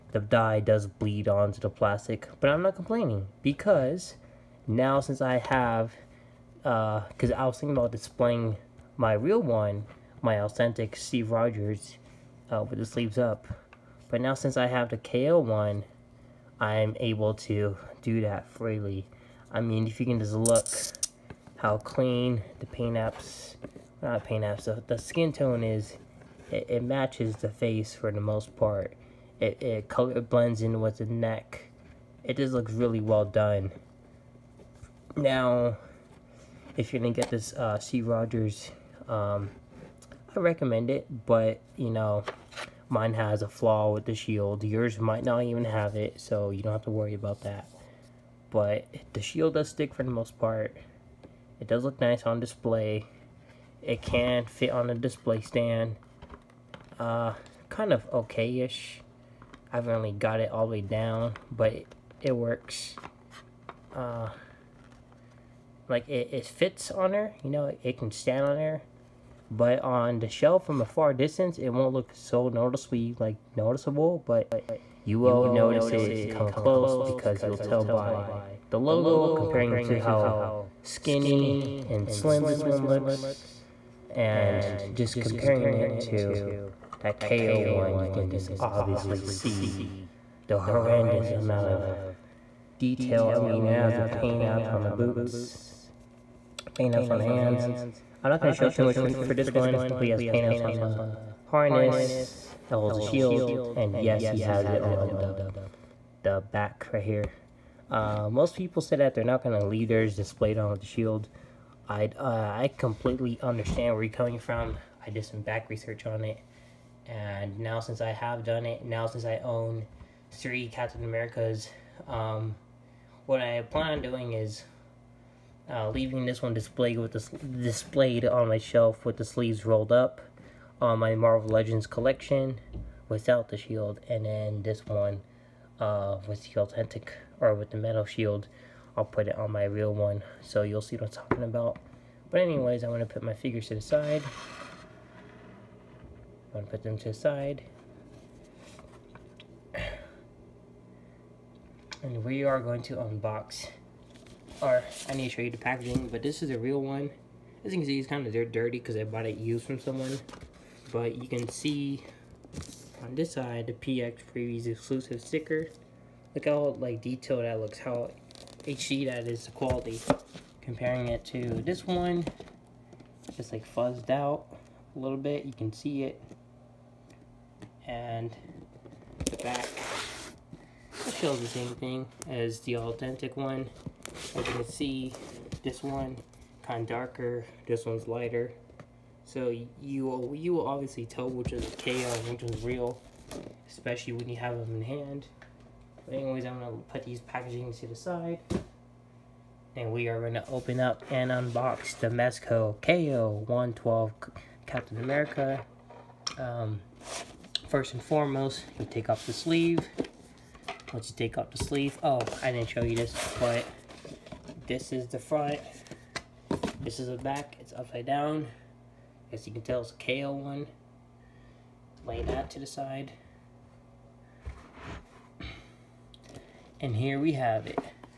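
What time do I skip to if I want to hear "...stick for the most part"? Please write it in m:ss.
0:49.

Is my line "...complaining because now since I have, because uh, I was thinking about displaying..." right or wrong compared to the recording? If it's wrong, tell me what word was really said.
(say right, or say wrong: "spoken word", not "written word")
right.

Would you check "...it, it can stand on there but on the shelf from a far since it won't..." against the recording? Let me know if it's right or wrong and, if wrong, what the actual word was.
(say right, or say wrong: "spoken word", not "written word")
wrong: "distance", not "since".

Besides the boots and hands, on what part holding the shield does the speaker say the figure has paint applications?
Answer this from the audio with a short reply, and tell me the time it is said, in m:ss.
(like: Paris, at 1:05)
the harness, at 1:41.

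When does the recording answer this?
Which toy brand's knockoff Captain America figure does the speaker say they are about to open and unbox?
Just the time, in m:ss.
3:22.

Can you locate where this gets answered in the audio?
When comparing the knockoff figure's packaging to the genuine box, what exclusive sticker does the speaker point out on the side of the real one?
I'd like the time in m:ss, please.
2:43.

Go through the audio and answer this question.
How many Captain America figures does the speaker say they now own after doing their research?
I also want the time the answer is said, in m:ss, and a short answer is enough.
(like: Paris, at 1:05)
3, at 2:00.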